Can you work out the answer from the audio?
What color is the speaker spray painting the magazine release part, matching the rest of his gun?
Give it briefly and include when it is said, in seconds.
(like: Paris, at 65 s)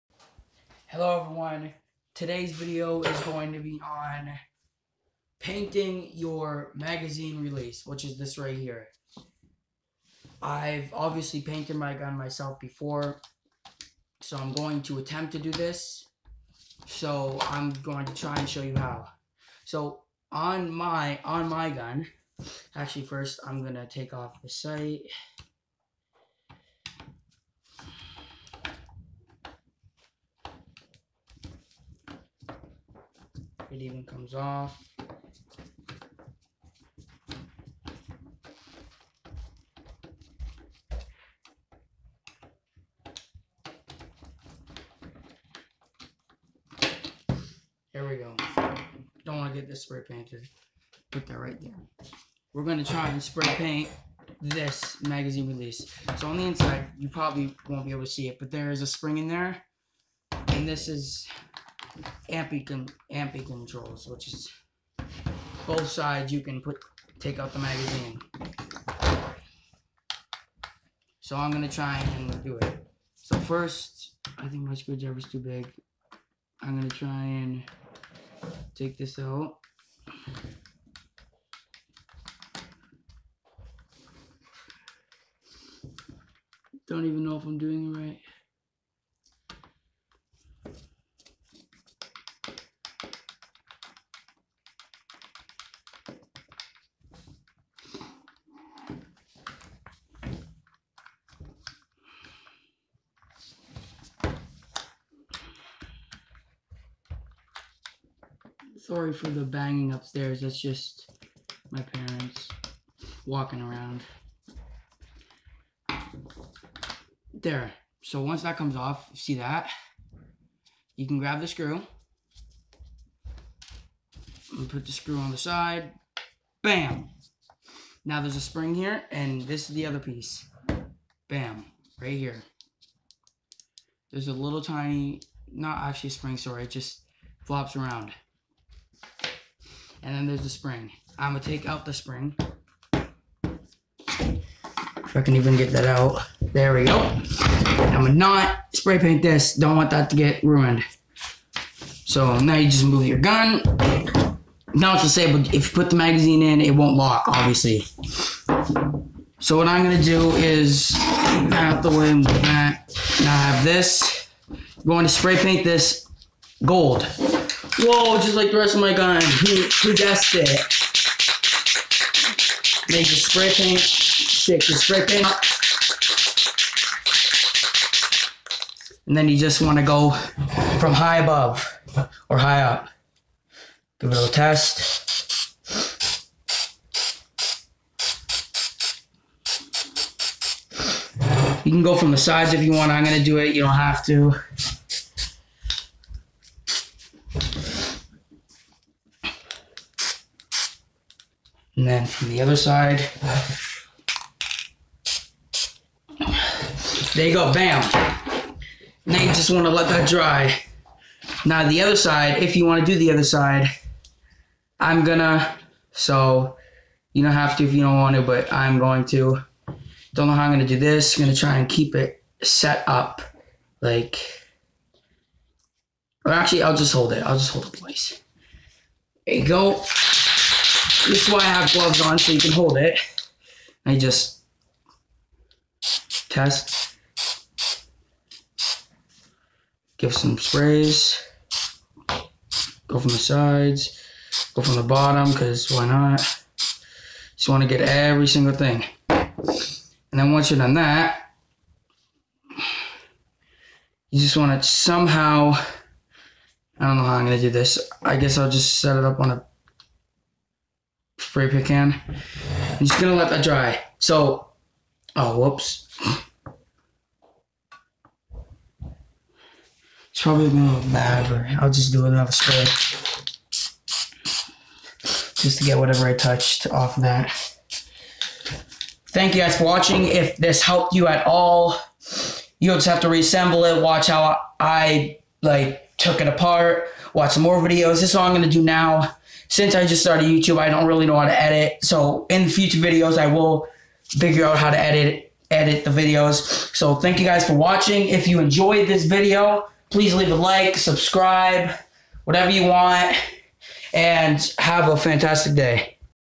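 gold, at 166 s.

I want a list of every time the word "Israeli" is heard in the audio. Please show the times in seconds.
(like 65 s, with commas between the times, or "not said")
not said.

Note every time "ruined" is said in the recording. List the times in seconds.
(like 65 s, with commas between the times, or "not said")
150 s.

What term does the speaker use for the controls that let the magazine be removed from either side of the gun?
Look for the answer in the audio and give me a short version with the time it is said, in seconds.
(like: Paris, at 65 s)
ambi controls, at 63 s.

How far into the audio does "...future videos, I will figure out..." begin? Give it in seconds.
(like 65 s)
292 s.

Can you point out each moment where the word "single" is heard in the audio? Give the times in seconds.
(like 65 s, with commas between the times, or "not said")
248 s.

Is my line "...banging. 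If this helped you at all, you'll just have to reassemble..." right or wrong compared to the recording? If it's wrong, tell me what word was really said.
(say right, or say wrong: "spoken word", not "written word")
wrong: "watching", not "banging".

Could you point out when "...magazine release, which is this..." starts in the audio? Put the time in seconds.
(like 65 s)
6 s.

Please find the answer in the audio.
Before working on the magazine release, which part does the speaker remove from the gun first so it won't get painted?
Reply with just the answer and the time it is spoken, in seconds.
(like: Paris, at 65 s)
the sight, at 24 s.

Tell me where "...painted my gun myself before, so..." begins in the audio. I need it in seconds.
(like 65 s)
11 s.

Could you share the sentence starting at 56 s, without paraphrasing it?
So on the inside, you probably won't be able to see it, but there is a spring in there.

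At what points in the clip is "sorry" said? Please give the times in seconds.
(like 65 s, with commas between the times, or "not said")
108 s, 136 s.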